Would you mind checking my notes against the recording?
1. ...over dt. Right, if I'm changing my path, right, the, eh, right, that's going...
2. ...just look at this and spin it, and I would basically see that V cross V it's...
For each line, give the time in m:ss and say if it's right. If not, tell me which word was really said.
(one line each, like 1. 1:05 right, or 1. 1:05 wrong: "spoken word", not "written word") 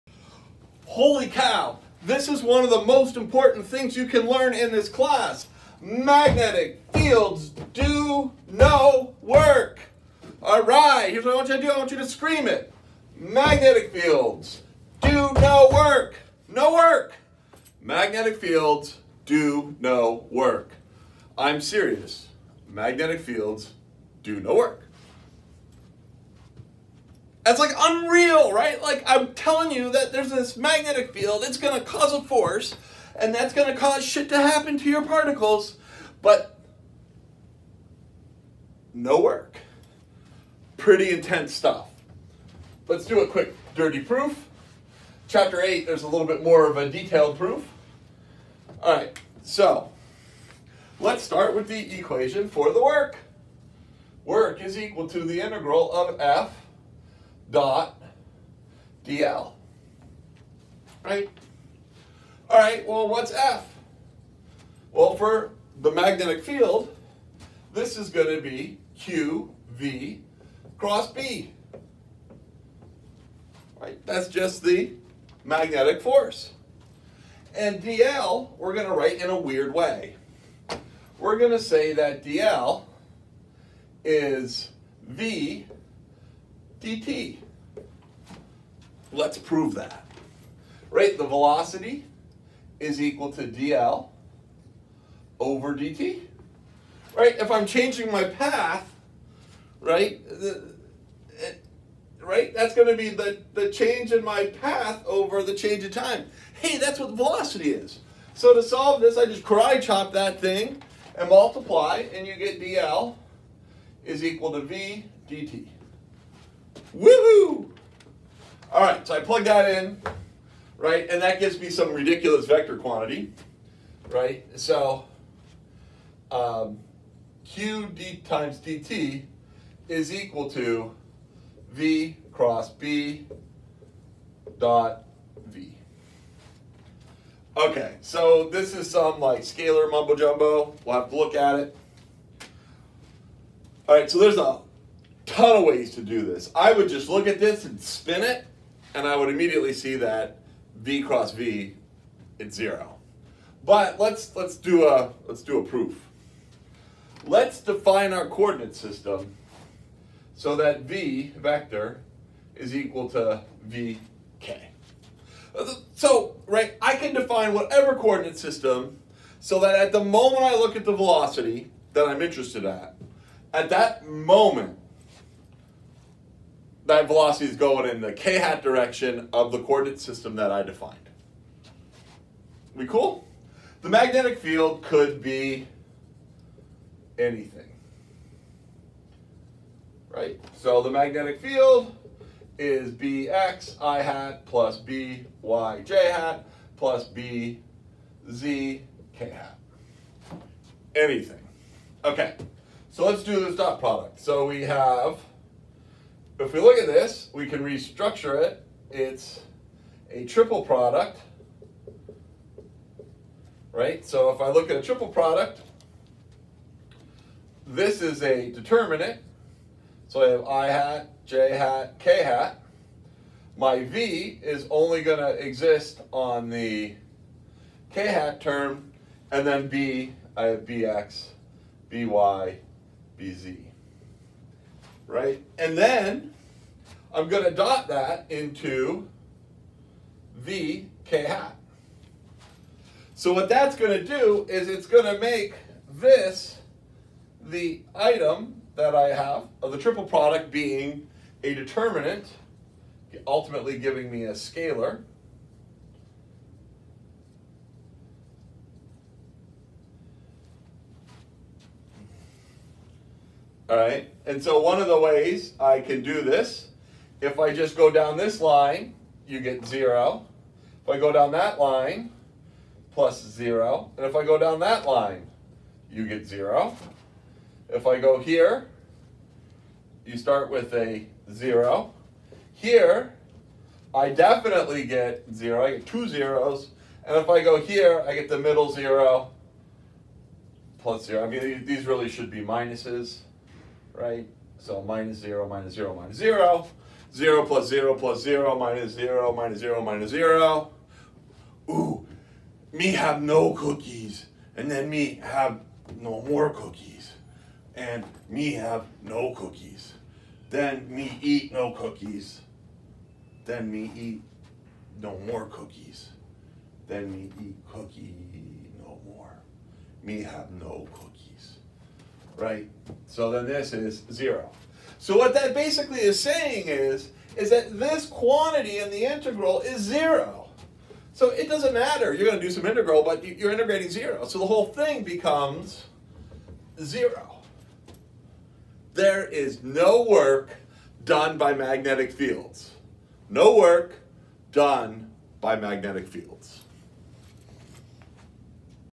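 1. 1:35 right
2. 2:26 wrong: "immediately", not "basically".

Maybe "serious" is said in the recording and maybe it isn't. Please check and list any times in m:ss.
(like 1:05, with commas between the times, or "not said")
0:21.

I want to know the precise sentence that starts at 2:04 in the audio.
So um, q d times dt is equal to v cross b dot v.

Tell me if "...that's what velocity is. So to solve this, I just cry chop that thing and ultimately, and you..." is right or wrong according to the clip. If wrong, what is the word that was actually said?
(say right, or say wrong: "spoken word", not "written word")
wrong: "multiply", not "ultimately".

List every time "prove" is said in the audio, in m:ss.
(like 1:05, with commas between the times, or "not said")
1:29.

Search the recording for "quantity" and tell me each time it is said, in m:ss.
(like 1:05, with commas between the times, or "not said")
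2:02, 5:28.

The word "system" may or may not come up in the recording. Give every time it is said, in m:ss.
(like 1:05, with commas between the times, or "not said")
2:38, 2:48, 2:59.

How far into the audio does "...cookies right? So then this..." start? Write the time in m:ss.
5:20.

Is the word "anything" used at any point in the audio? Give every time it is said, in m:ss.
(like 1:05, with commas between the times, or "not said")
3:07, 3:20.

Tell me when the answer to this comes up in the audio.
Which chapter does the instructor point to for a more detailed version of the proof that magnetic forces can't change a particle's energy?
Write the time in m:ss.
0:45.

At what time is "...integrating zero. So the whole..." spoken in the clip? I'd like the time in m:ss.
5:33.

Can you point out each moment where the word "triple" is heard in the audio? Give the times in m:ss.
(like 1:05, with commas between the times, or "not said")
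3:30, 3:34, 4:09.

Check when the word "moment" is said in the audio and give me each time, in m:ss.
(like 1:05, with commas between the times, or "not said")
2:50, 2:54.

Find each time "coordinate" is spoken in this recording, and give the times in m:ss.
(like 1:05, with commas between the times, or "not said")
2:38, 2:47, 2:59.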